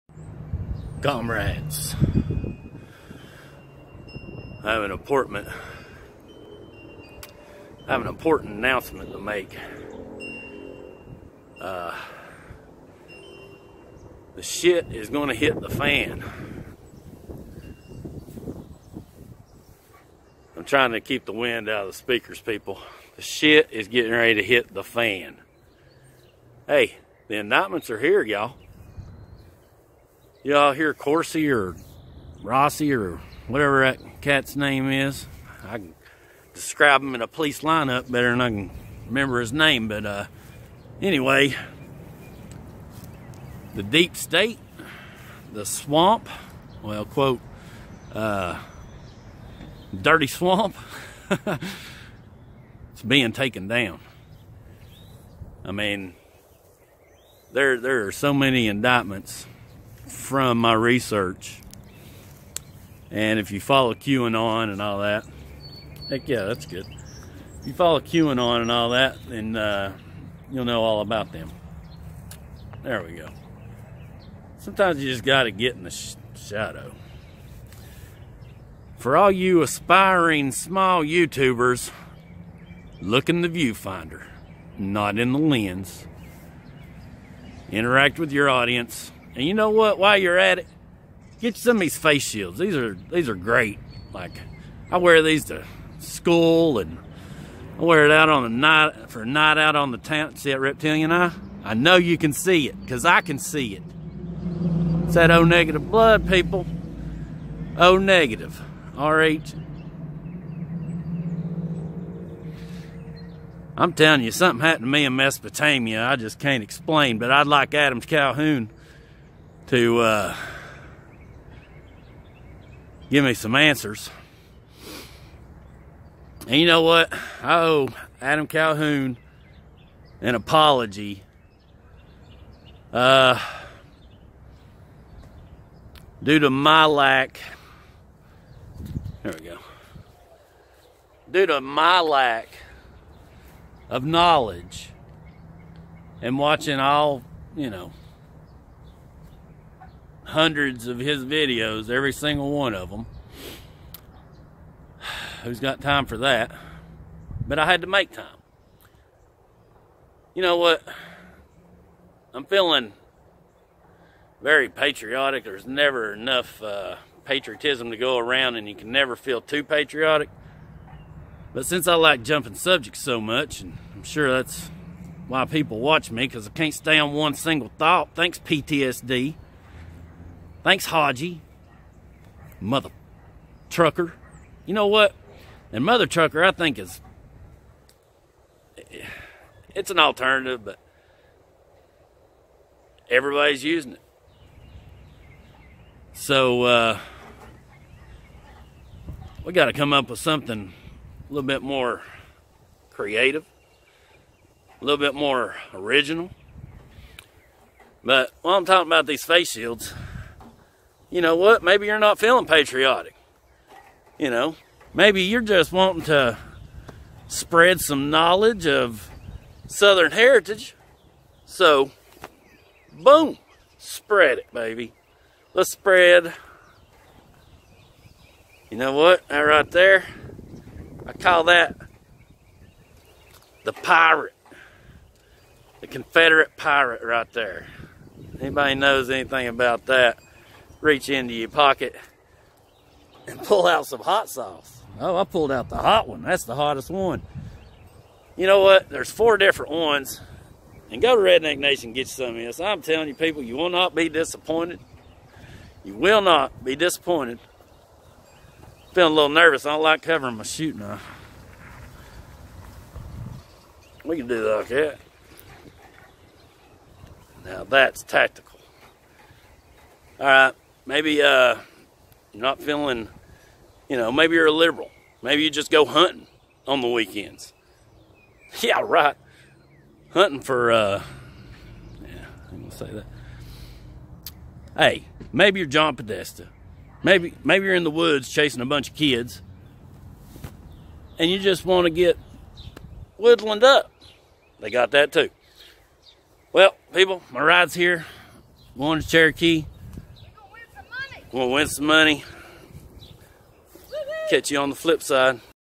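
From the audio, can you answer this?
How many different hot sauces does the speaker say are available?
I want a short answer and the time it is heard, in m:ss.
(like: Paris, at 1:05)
4, at 4:09.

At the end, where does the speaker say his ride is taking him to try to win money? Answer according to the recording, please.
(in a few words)
Cherokee.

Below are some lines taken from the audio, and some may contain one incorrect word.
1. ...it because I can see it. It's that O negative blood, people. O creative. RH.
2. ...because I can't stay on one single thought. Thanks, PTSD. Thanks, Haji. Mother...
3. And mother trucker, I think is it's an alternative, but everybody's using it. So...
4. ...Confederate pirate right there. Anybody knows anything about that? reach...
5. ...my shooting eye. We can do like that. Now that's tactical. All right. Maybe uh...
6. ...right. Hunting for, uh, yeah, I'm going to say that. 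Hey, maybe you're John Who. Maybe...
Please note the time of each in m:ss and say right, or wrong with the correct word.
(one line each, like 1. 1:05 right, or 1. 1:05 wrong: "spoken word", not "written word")
1. 1:42 wrong: "negative", not "creative"
2. 2:56 right
3. 3:05 right
4. 3:55 right
5. 4:20 right
6. 4:38 wrong: "Podesta", not "Who".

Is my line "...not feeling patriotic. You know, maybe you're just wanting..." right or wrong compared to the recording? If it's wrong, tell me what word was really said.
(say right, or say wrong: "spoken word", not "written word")
right.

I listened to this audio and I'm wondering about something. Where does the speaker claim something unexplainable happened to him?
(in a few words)
Mesopotamia.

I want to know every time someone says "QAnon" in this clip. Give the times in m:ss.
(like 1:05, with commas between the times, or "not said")
1:03, 1:07.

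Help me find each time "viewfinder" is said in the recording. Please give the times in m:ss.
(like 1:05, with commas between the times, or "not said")
1:23.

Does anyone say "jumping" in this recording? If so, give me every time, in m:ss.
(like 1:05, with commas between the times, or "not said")
2:52.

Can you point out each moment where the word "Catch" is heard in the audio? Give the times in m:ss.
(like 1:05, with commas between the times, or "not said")
5:04.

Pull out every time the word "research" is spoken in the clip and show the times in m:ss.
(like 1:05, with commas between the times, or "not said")
1:00.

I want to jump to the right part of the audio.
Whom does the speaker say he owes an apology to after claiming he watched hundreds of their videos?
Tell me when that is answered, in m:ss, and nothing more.
2:08.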